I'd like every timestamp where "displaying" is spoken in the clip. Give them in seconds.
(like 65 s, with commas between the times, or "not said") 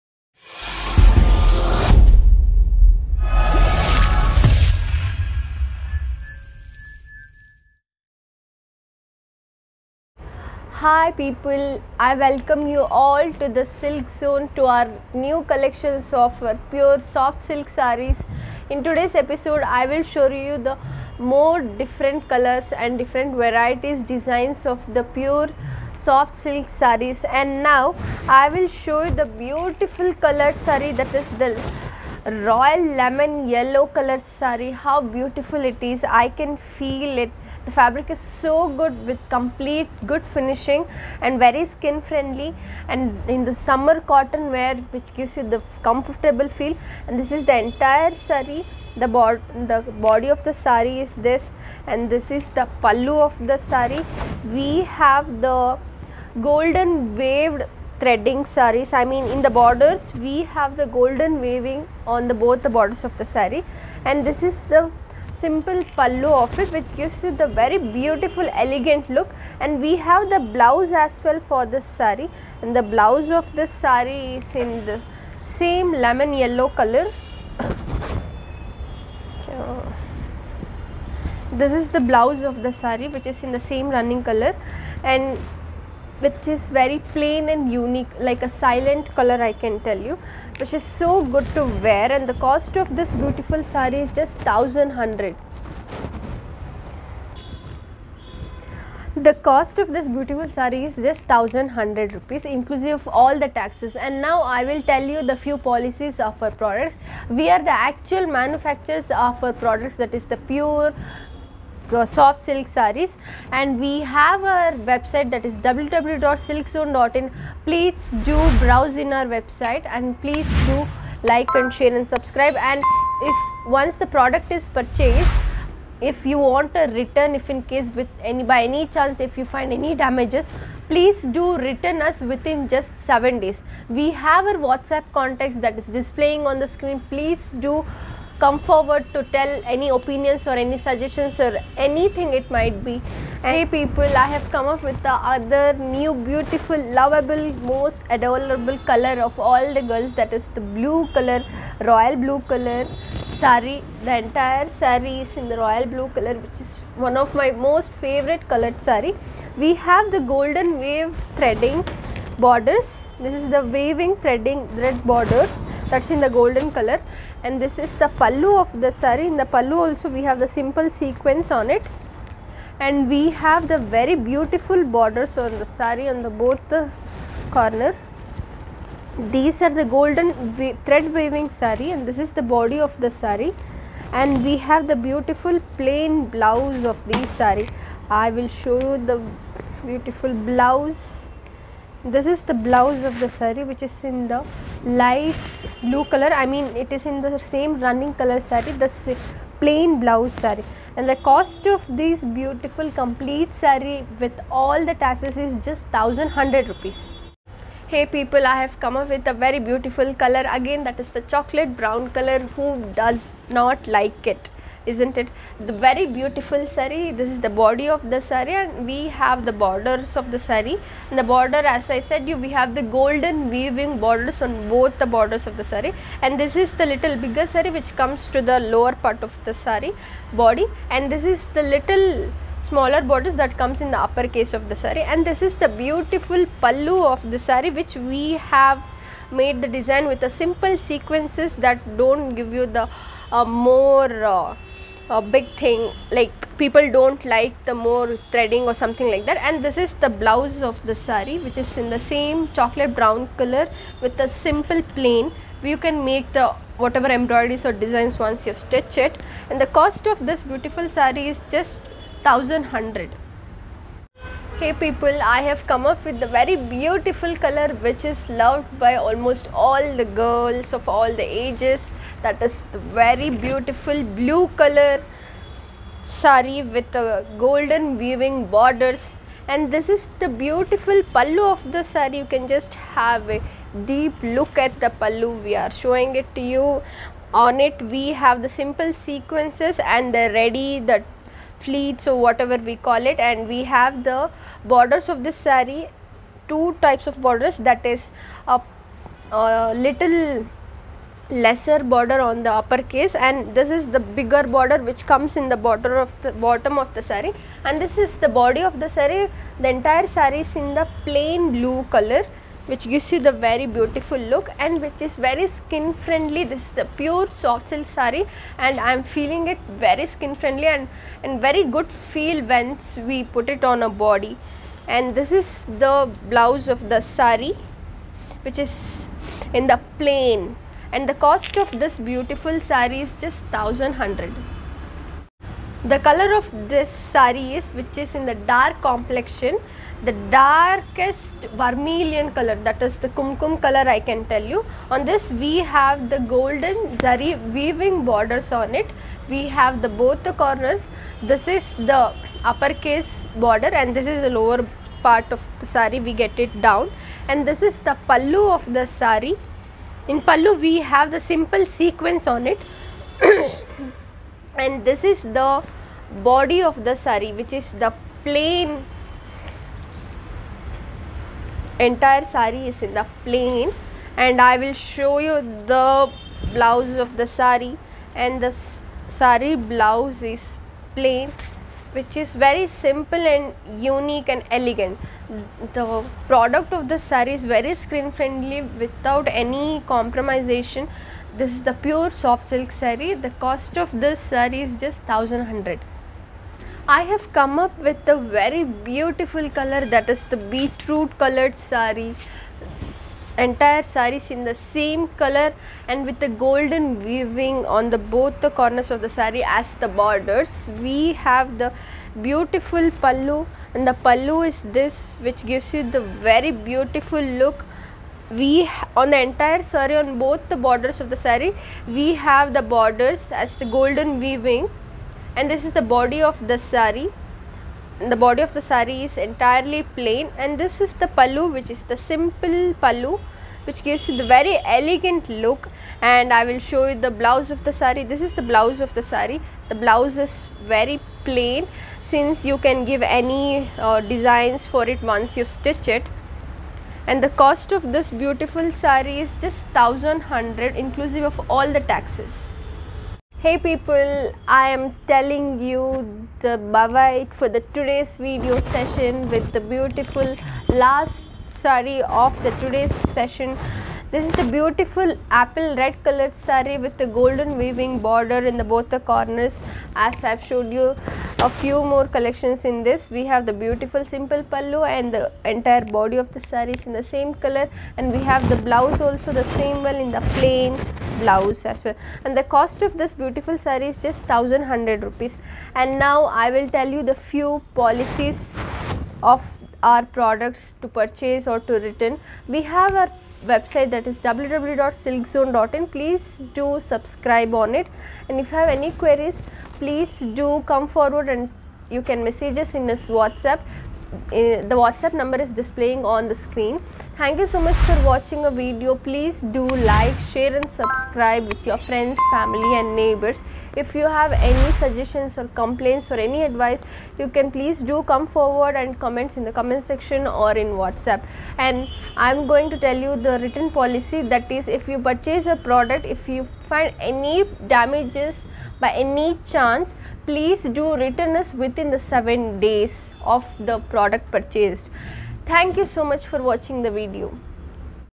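135 s, 505 s.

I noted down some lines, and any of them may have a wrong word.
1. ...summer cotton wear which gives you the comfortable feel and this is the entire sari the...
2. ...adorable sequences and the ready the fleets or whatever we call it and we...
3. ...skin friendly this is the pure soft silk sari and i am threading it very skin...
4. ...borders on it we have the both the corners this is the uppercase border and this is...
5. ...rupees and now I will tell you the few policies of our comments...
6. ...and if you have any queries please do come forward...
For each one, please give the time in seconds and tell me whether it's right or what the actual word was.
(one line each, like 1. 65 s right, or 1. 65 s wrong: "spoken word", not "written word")
1. 43 s right
2. 288 s wrong: "simple", not "adorable"
3. 315 s wrong: "feeling", not "threading"
4. 348 s right
5. 485 s wrong: "products", not "comments"
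6. 498 s right.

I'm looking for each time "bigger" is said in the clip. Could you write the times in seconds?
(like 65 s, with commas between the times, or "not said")
227 s, 303 s.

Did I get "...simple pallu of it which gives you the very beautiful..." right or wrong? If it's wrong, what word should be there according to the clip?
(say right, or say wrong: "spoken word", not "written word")
right.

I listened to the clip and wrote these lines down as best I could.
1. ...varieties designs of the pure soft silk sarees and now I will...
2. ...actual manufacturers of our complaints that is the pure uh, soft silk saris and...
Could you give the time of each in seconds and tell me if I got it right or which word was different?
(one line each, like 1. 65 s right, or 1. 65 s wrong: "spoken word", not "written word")
1. 23 s right
2. 107 s wrong: "products", not "complaints".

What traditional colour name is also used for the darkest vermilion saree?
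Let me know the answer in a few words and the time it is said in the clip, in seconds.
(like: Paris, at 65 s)
Kumkum, at 343 s.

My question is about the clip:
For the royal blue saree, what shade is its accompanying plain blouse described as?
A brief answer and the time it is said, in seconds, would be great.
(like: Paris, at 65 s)
Light blue, at 195 s.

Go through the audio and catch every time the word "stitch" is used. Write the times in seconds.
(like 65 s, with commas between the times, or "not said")
258 s, 445 s.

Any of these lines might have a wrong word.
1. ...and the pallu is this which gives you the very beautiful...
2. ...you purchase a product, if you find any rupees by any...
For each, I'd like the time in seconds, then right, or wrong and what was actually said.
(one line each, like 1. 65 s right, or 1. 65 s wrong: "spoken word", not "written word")
1. 413 s right
2. 524 s wrong: "damages", not "rupees".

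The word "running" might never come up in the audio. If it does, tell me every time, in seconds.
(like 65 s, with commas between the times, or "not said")
83 s, 197 s.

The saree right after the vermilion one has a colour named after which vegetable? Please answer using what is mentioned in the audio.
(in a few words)
Beetroot.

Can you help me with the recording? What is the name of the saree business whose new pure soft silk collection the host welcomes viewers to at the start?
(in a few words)
Silk Zone.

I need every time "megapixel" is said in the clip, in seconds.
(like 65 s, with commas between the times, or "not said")
not said.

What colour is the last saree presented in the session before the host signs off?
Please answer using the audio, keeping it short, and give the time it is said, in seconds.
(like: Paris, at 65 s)
Apple red, at 465 s.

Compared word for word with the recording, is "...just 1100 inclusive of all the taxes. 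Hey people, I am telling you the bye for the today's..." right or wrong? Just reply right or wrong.
right.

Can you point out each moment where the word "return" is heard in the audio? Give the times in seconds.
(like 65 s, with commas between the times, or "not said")
126 s, 131 s, 491 s, 530 s.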